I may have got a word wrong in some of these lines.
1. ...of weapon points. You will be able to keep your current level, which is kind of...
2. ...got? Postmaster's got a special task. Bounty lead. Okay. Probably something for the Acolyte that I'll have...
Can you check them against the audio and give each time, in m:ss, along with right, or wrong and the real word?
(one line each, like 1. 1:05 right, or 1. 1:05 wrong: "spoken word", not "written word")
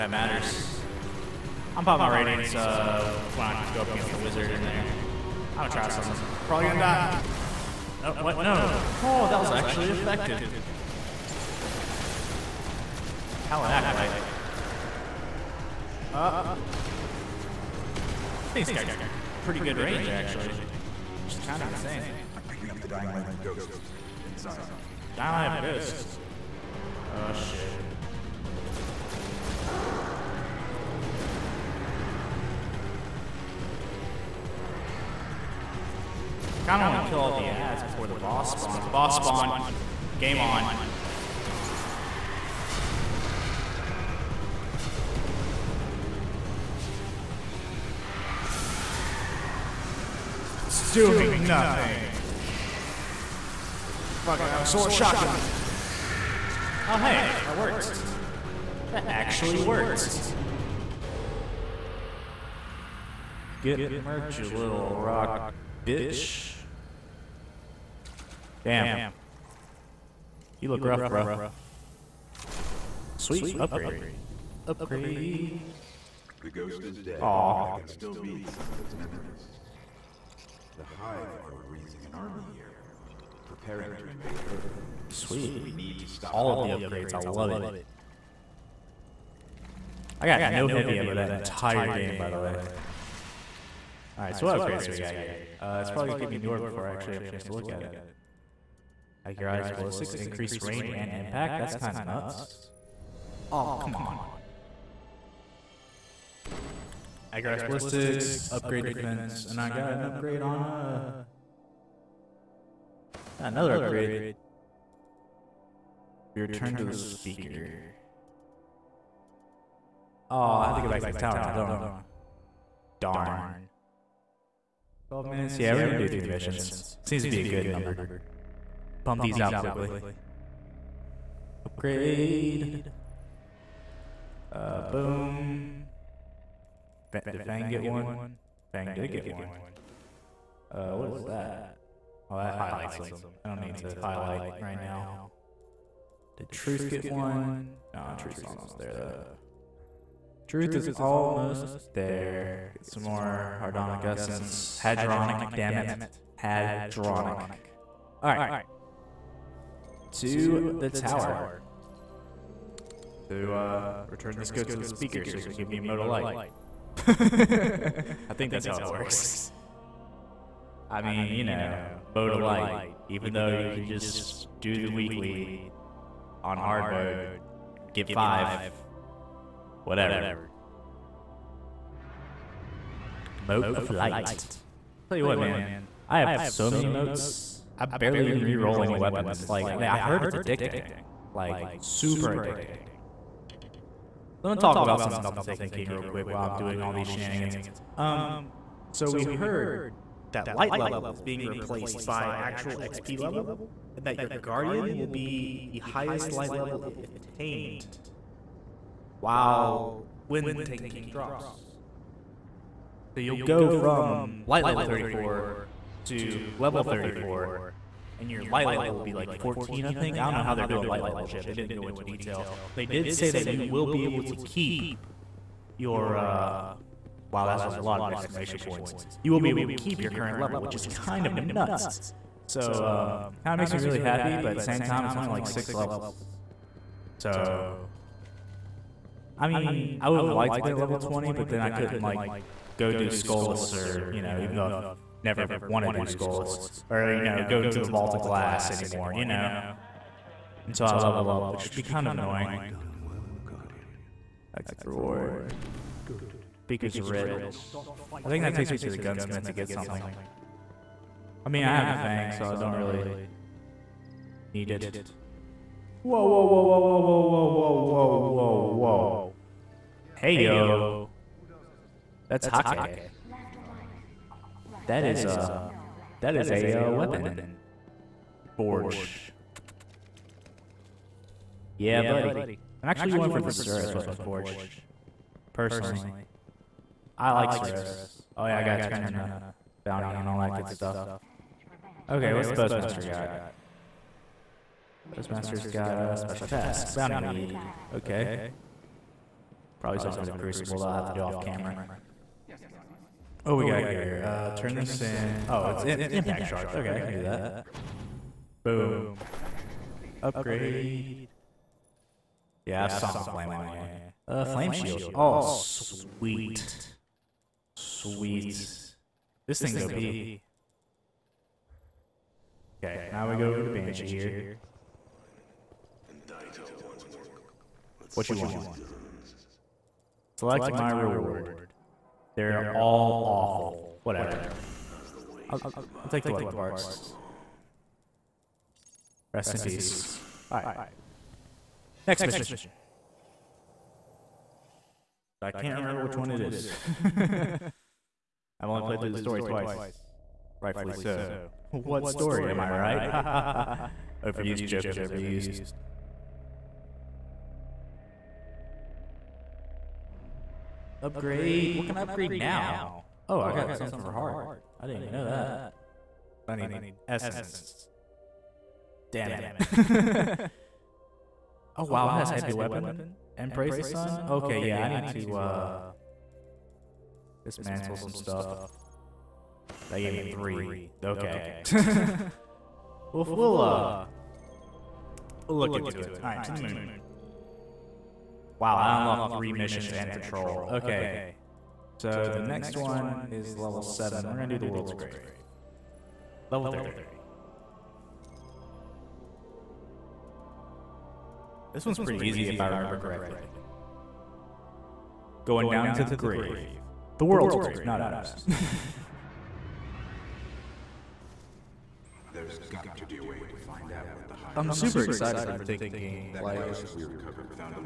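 1. 3:47 wrong: "exclamation", not "weapon"
2. 4:53 wrong: "Crucible", not "Acolyte".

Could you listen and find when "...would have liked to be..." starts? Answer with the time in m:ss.
4:00.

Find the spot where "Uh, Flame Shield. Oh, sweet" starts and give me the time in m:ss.
5:14.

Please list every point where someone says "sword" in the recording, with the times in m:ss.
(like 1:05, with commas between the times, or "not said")
0:54.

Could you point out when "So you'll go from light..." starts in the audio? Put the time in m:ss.
3:33.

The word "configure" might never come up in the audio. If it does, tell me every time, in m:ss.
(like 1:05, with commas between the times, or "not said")
not said.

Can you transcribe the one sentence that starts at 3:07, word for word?
I barely even re-roll any weapons.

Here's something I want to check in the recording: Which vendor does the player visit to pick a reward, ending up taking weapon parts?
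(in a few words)
Banshee.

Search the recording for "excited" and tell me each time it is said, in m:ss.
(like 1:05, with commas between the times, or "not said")
6:55.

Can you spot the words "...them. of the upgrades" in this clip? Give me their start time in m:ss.
1:26.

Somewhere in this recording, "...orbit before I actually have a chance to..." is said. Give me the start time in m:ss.
1:36.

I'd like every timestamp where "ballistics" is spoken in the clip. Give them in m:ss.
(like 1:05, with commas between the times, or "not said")
1:39, 1:47.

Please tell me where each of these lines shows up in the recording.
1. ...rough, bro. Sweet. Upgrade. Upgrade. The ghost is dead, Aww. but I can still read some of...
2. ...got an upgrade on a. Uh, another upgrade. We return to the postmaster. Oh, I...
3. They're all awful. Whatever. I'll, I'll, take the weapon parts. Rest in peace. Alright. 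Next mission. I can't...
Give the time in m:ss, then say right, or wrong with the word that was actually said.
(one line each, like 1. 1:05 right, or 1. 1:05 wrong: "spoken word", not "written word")
1. 1:10 right
2. 1:49 wrong: "speaker", not "postmaster"
3. 5:32 right.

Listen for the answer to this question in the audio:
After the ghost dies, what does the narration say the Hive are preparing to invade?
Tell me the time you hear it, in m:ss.
1:23.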